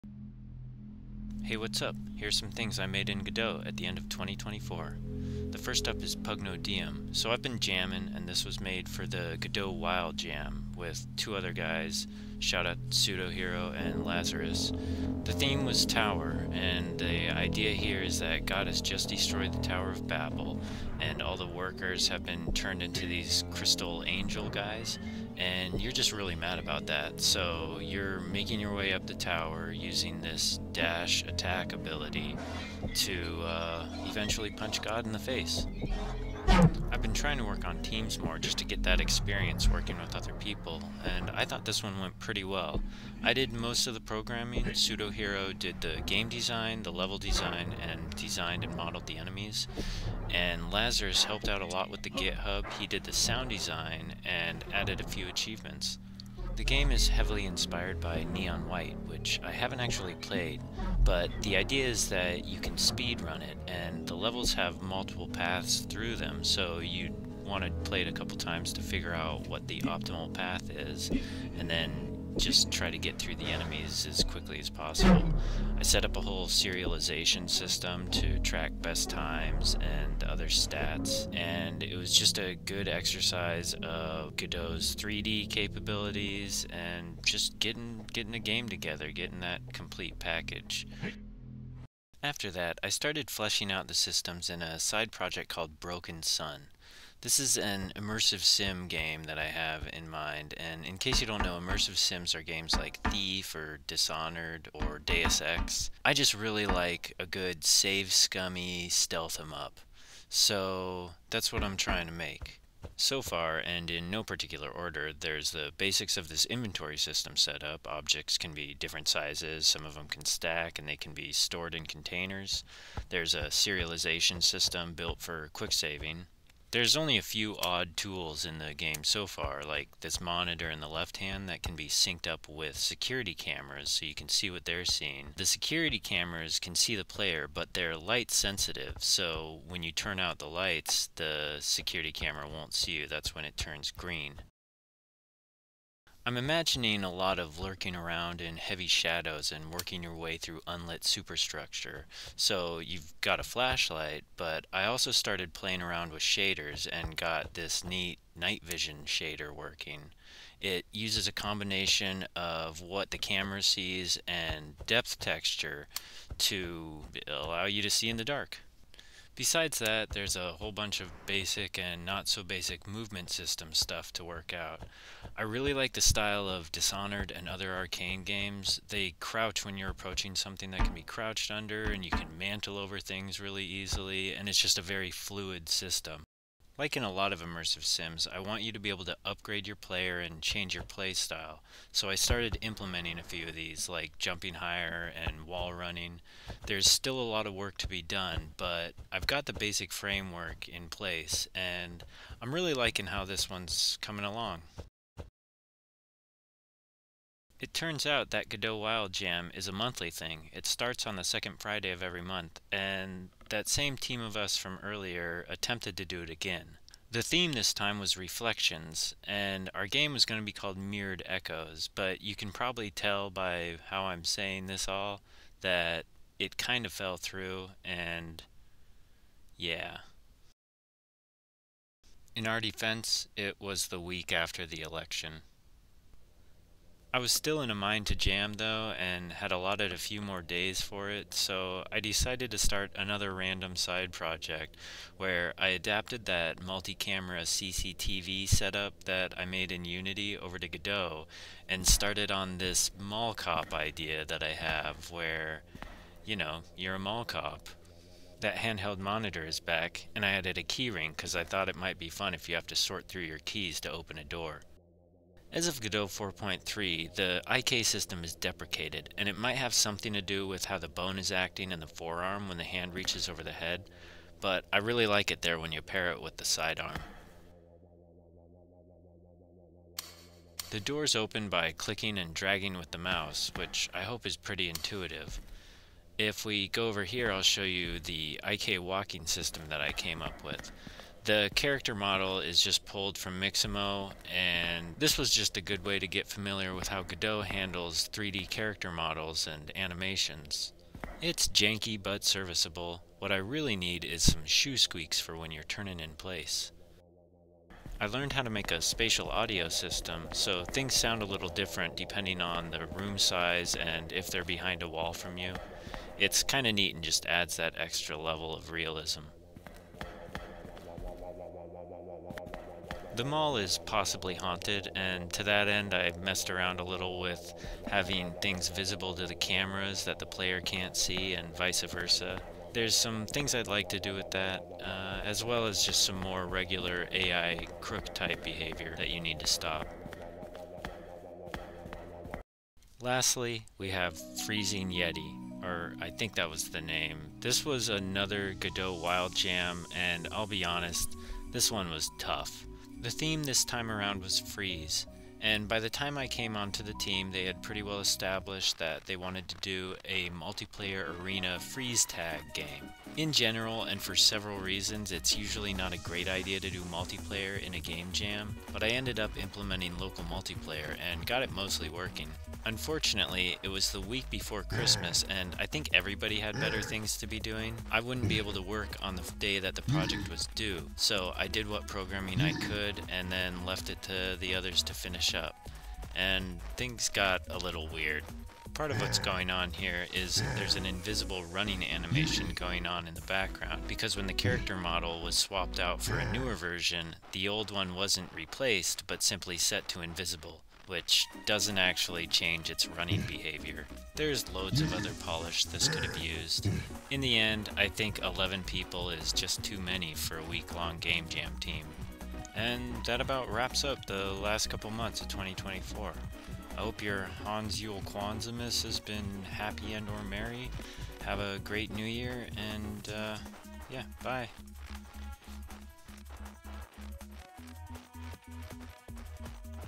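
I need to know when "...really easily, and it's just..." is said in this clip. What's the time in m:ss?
3:03.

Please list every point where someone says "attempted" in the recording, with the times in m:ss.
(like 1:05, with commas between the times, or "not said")
3:35.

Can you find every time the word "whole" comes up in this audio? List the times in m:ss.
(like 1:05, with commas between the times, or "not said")
1:16, 2:50.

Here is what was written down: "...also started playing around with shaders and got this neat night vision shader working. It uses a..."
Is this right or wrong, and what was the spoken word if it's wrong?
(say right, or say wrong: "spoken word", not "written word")
right.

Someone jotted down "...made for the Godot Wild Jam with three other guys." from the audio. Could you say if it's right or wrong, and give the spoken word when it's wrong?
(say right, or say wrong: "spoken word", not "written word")
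wrong: "two", not "three".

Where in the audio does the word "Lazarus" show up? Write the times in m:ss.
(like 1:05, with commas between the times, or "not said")
0:14, 0:50.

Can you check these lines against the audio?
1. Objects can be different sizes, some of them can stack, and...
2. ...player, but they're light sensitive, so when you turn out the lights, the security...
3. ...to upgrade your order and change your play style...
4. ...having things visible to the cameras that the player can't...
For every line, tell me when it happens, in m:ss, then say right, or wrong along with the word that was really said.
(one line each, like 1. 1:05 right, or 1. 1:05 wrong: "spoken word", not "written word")
1. 1:57 right
2. 2:17 right
3. 3:09 wrong: "player", not "order"
4. 5:27 right.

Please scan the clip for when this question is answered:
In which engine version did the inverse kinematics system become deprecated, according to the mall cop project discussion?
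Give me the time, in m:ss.
4:25.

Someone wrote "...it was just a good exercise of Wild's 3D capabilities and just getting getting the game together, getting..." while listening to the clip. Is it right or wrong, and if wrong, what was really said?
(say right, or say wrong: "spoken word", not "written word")
wrong: "Godot", not "Wild".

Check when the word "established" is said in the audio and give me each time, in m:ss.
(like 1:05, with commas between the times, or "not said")
5:57.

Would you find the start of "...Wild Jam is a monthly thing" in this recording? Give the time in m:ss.
3:28.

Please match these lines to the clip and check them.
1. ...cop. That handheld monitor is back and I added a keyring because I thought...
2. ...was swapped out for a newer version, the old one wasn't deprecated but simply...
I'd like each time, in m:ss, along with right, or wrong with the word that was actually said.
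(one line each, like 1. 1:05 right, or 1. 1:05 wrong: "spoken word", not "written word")
1. 4:17 right
2. 6:35 wrong: "replaced", not "deprecated".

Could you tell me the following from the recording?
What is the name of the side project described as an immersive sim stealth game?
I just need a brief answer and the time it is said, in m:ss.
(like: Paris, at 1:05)
Broken Sun, at 1:35.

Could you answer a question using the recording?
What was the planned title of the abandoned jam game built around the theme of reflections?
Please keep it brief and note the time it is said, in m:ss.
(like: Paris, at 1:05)
Mirrored Echoes, at 3:40.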